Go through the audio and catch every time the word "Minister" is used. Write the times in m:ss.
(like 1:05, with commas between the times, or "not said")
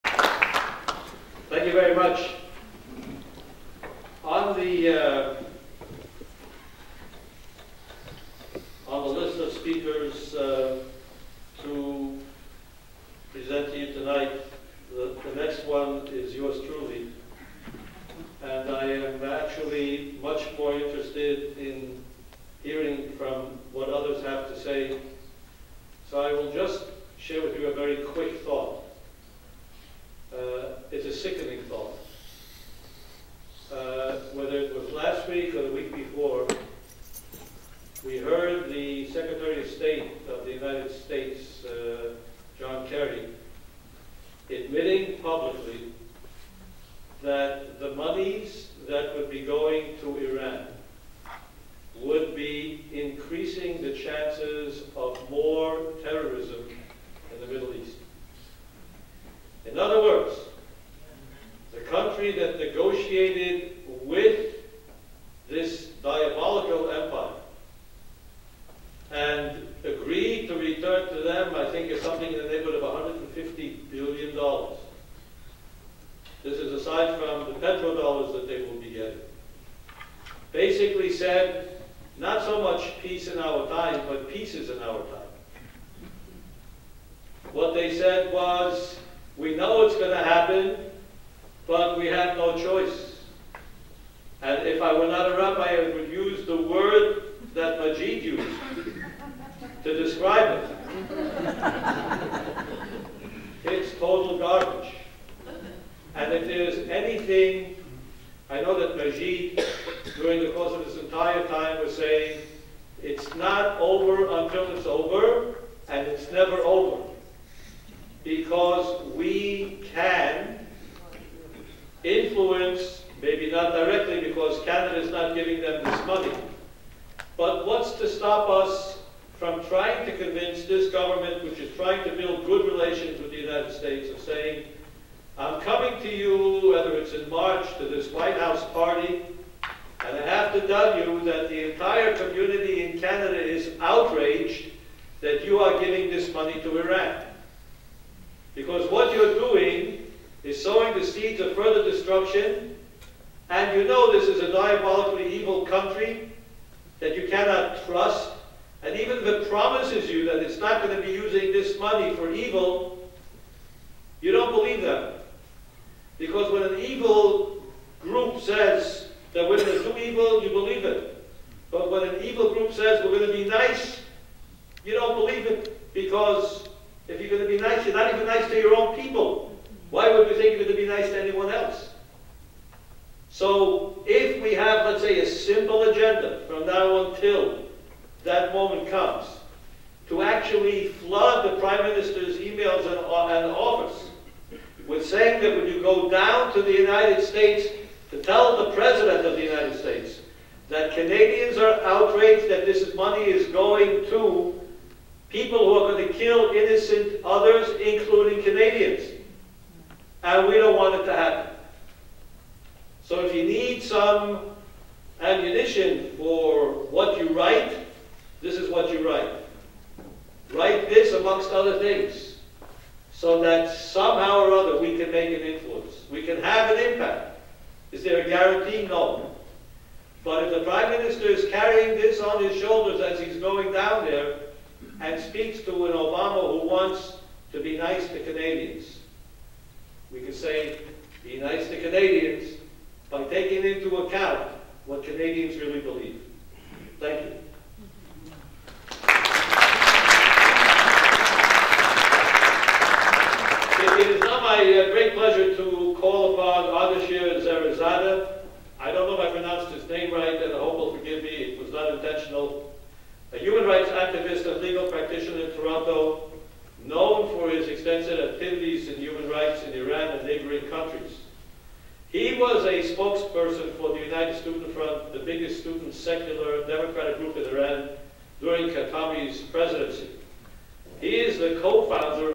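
3:11, 3:50.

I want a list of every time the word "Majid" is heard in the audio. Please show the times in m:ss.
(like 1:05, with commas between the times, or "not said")
1:37, 1:48.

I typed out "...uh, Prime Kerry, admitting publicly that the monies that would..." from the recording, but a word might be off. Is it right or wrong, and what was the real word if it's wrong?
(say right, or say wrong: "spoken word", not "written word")
wrong: "John", not "Prime".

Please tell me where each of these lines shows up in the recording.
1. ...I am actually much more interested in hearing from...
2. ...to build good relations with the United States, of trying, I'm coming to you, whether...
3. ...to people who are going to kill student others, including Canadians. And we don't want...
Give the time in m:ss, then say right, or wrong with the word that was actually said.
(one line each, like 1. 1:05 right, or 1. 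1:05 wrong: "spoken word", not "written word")
1. 0:18 right
2. 2:12 wrong: "saying", not "trying"
3. 3:24 wrong: "innocent", not "student".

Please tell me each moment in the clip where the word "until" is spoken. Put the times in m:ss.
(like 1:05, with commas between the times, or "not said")
1:54, 3:07.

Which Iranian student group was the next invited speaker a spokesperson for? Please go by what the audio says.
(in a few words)
United Student Front.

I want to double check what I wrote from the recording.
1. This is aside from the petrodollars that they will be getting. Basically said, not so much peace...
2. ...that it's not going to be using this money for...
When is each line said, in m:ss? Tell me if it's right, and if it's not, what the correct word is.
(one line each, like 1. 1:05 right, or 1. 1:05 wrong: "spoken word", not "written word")
1. 1:16 right
2. 2:40 right.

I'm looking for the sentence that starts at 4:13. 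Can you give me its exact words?
It is now my uh, great pleasure to call upon Adeshir Zarazada.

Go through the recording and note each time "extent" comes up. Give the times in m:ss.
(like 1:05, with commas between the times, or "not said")
not said.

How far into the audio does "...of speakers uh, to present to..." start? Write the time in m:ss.
0:09.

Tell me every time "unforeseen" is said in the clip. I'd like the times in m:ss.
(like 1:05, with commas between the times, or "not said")
not said.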